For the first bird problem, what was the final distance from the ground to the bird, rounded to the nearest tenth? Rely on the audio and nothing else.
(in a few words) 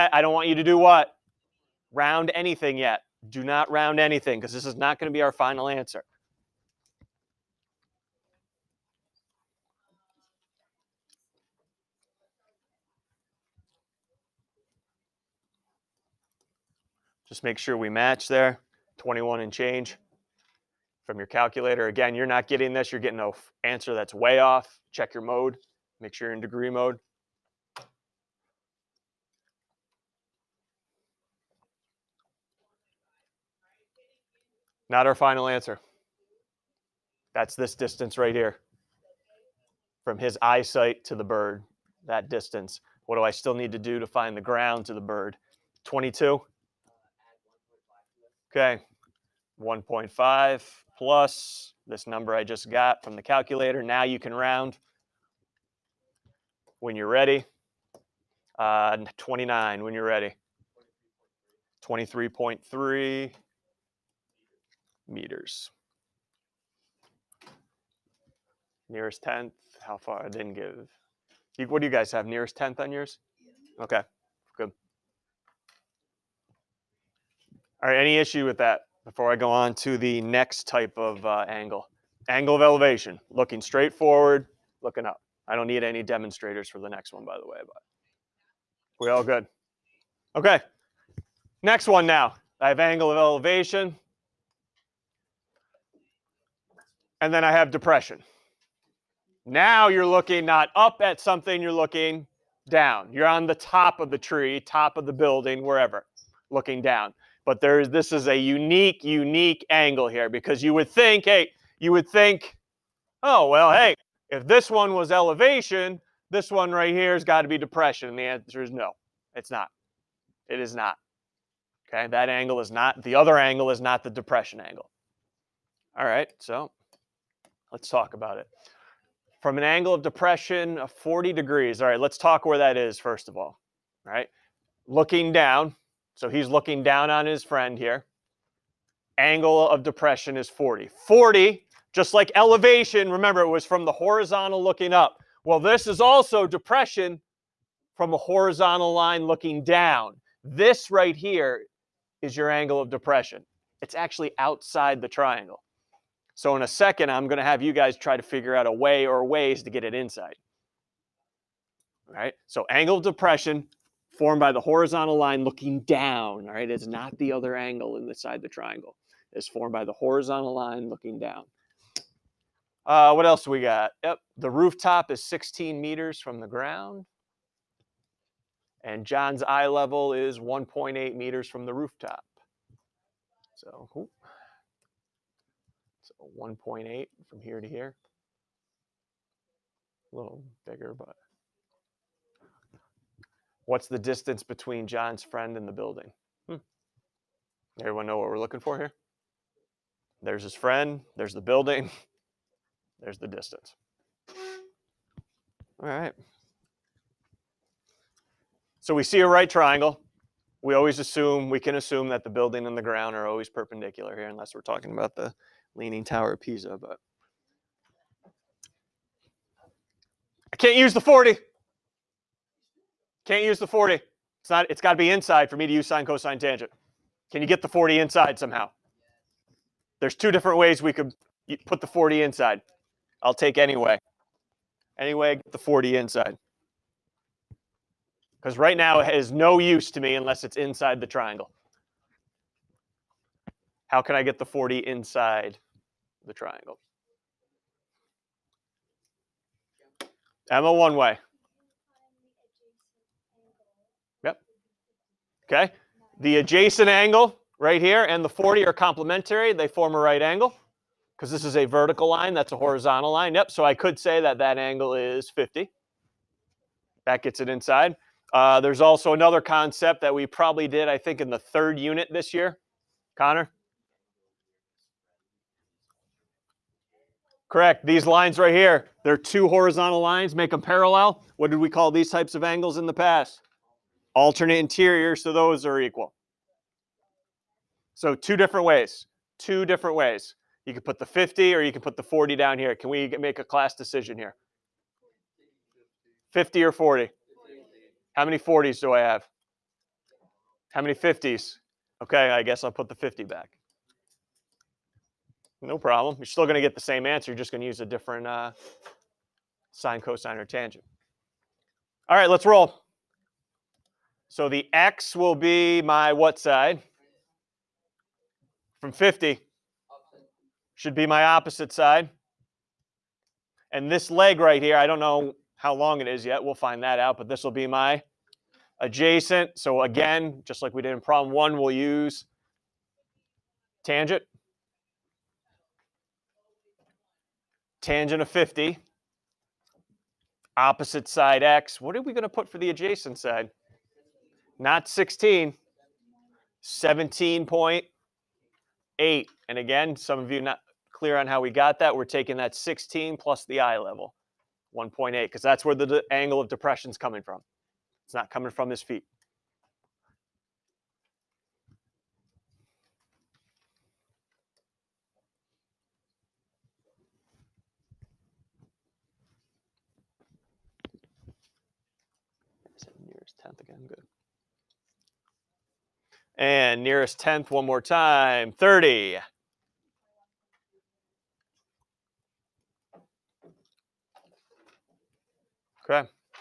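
23.3 meters.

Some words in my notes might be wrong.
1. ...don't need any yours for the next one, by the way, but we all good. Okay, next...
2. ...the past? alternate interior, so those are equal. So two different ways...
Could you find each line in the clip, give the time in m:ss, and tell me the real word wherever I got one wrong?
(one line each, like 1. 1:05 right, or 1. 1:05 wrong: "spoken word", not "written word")
1. 1:25 wrong: "demonstrators", not "yours"
2. 4:42 right.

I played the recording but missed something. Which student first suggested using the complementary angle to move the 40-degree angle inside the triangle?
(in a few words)
Emma.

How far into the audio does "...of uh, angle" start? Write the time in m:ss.
1:20.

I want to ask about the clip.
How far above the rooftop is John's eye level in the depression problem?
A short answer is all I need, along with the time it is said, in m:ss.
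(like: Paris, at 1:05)
1.8 meters, at 3:00.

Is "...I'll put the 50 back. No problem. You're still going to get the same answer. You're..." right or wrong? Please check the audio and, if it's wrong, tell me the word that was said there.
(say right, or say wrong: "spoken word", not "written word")
right.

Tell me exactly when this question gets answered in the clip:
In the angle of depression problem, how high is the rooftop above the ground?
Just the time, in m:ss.
2:55.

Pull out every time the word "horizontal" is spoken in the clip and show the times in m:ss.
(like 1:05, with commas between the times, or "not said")
2:23, 2:28, 2:44, 2:49, 4:22, 4:39.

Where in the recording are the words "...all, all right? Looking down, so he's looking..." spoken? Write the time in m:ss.
2:13.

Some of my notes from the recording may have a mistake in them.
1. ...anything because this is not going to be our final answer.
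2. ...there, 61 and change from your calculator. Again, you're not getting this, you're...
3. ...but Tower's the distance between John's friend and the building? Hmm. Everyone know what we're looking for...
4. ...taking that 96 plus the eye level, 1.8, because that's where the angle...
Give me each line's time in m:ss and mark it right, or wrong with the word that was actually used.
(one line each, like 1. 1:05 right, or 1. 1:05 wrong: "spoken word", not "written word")
1. 0:03 right
2. 0:18 wrong: "21", not "61"
3. 3:10 wrong: "What", not "Tower"
4. 5:52 wrong: "16", not "96".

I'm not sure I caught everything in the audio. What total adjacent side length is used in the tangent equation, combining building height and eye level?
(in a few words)
17.8.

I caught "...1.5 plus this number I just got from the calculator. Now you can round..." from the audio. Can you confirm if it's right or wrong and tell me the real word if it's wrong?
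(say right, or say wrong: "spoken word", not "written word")
right.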